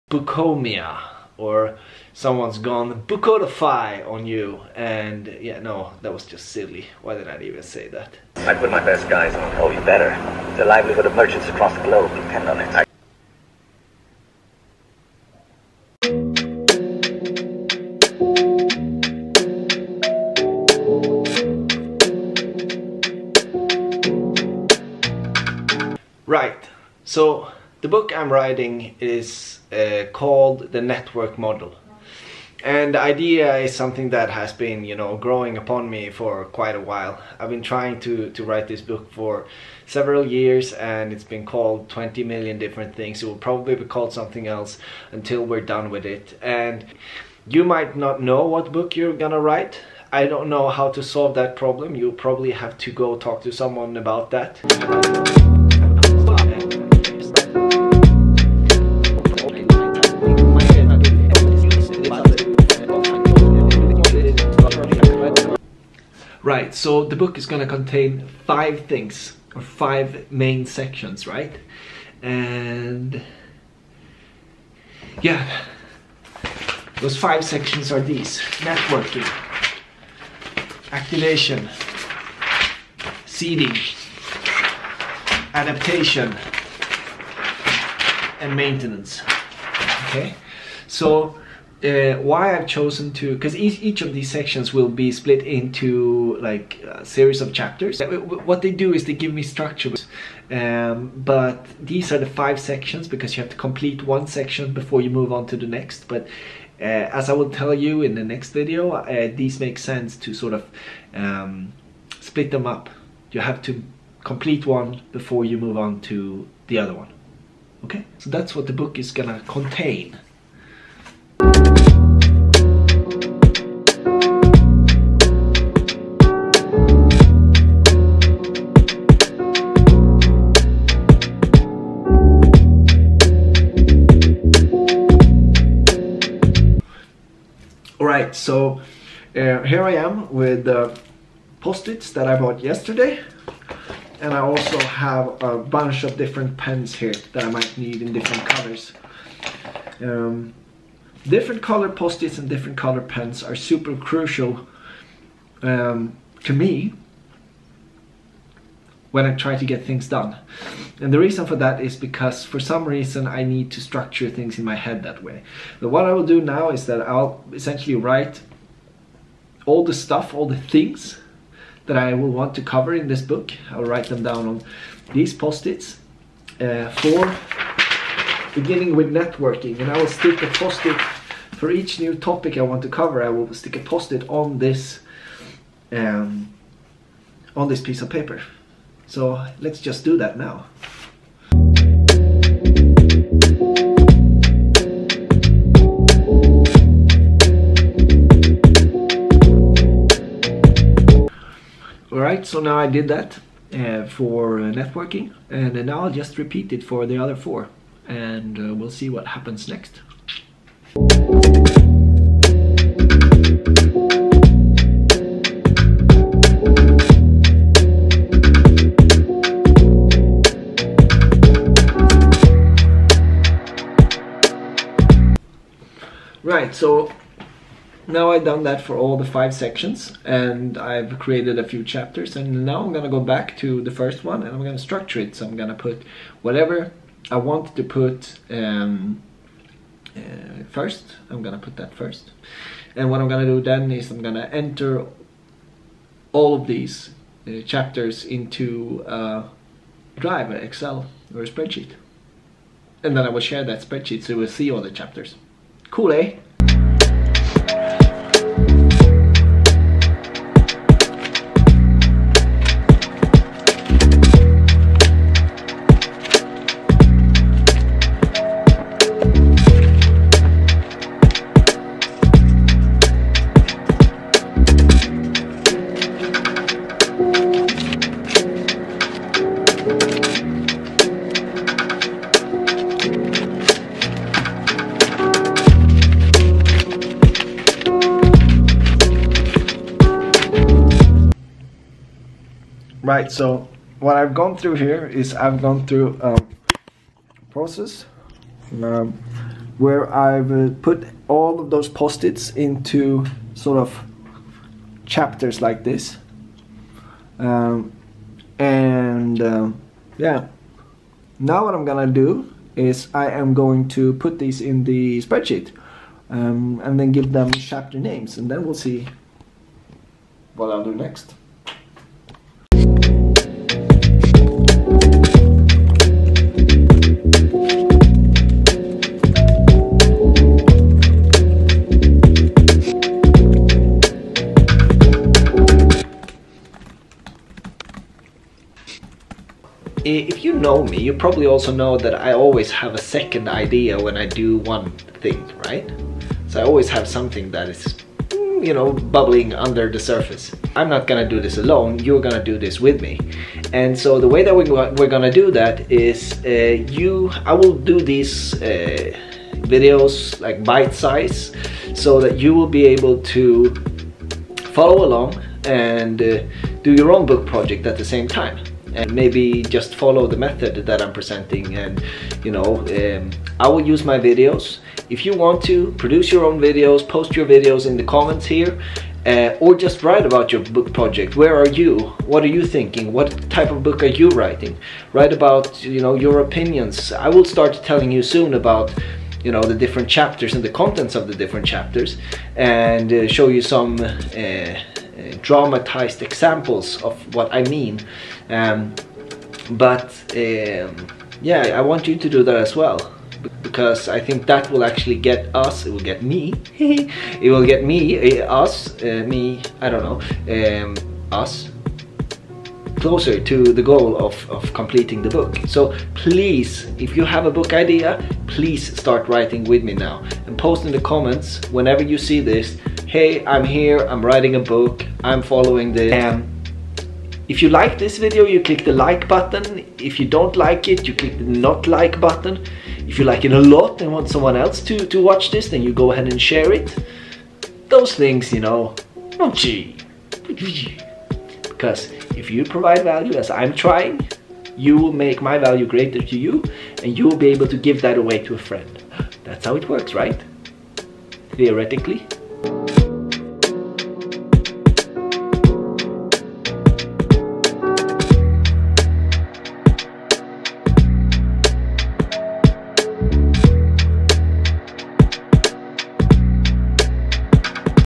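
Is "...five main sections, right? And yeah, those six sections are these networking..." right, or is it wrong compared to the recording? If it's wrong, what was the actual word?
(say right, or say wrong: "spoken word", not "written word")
wrong: "five", not "six".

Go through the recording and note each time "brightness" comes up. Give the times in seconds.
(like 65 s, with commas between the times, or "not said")
not said.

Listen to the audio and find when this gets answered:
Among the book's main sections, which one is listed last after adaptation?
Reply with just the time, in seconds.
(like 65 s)
88 s.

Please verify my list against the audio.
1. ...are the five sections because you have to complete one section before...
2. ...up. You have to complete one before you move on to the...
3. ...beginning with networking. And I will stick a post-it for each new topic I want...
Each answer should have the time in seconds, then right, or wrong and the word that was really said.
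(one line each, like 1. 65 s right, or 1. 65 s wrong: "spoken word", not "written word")
1. 102 s right
2. 112 s right
3. 178 s right.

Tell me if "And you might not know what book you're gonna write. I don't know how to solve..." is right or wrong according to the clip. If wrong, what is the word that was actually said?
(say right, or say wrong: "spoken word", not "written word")
right.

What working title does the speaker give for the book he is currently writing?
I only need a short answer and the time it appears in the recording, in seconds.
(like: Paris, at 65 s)
The Network Model, at 30 s.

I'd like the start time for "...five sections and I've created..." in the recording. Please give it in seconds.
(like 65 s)
229 s.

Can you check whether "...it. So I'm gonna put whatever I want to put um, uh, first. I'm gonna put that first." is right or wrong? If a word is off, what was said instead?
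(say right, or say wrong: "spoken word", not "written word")
right.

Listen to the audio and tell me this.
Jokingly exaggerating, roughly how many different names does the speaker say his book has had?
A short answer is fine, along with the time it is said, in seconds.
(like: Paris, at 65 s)
20 million, at 41 s.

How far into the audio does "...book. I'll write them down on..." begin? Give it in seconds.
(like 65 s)
173 s.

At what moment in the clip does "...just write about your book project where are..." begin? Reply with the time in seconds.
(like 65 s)
379 s.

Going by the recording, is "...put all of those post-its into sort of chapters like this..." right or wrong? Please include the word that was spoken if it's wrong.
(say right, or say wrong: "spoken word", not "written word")
right.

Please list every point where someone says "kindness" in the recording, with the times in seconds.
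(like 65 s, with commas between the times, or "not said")
not said.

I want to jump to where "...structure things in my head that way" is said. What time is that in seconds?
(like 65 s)
163 s.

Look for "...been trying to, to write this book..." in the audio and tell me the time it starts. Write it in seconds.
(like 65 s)
37 s.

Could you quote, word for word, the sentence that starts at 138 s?
right, so uh, here I am with post-its that I bought yesterday.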